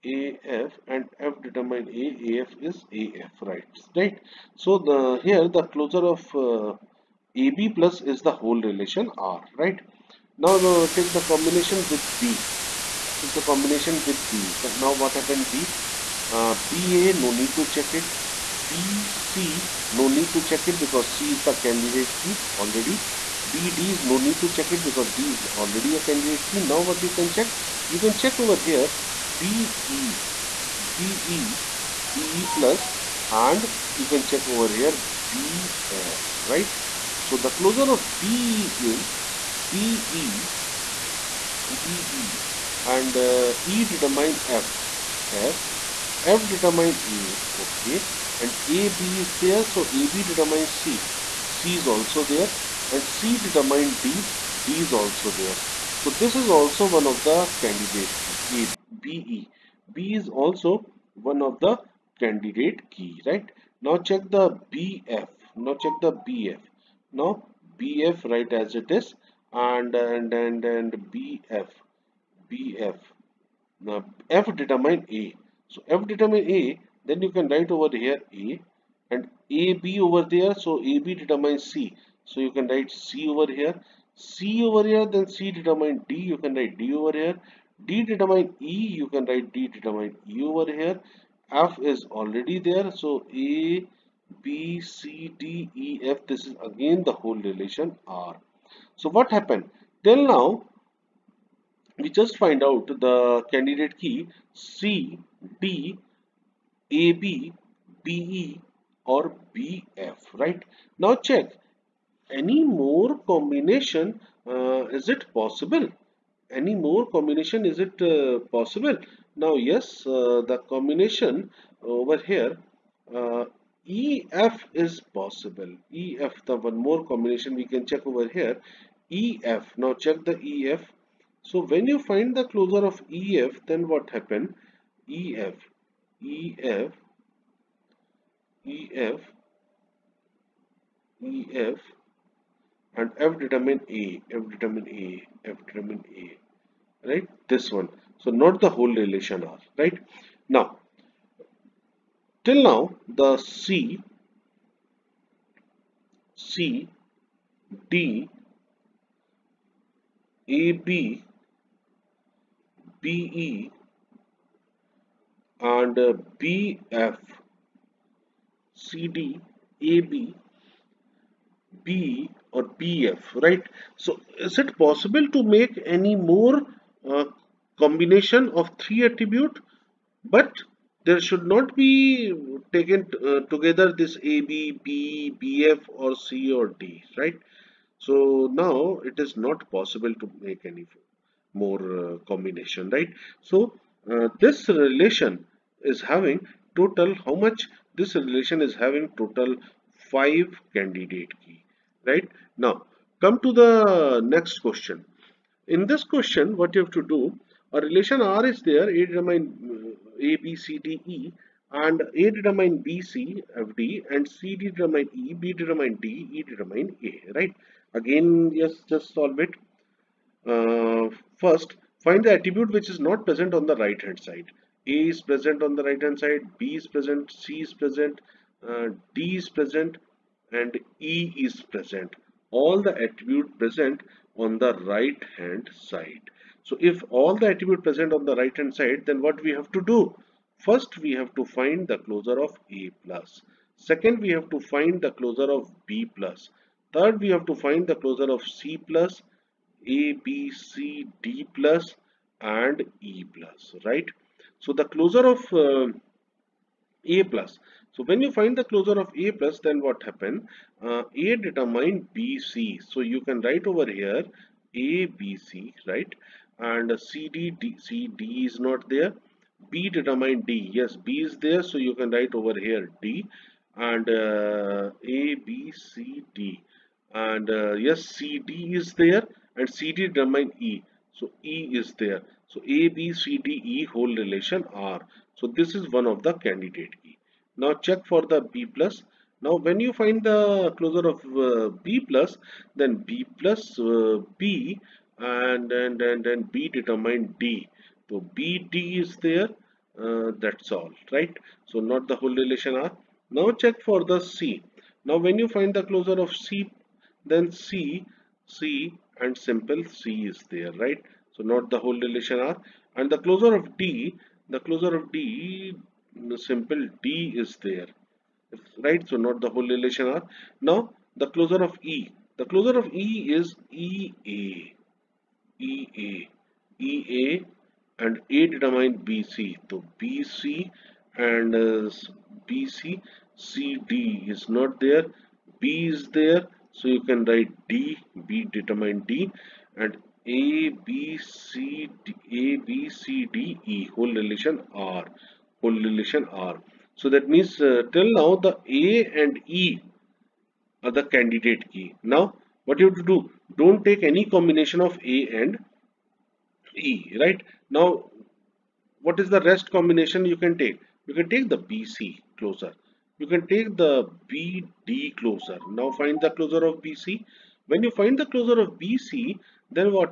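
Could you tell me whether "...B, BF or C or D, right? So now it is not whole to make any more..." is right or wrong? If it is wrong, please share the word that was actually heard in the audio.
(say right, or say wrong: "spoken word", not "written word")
wrong: "possible", not "whole".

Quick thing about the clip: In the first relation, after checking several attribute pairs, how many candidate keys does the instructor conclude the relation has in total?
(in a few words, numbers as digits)
5.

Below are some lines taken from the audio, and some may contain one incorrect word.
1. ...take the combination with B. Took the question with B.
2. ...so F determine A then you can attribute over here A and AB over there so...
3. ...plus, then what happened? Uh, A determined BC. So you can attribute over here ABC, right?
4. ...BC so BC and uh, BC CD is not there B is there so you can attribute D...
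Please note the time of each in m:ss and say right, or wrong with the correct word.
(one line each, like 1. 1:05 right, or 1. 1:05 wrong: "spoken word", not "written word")
1. 0:10 wrong: "combination", not "question"
2. 1:15 wrong: "write", not "attribute"
3. 4:19 wrong: "write", not "attribute"
4. 5:28 wrong: "write", not "attribute".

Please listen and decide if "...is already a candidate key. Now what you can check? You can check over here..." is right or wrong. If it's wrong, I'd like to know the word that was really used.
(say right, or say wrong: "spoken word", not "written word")
right.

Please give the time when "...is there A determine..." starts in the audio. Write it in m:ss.
3:28.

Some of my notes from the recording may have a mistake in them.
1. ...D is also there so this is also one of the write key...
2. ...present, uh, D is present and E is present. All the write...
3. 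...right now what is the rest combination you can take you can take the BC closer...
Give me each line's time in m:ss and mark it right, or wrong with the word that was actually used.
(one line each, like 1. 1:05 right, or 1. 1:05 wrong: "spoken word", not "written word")
1. 0:54 wrong: "candidate", not "write"
2. 3:47 wrong: "attribute", not "write"
3. 5:57 right.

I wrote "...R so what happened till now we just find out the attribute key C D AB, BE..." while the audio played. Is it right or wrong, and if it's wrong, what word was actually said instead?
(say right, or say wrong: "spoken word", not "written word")
wrong: "candidate", not "attribute".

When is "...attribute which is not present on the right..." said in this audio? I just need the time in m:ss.
3:42.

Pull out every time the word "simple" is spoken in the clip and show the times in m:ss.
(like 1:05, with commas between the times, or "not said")
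5:09, 5:16.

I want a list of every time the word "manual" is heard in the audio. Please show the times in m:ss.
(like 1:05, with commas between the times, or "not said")
not said.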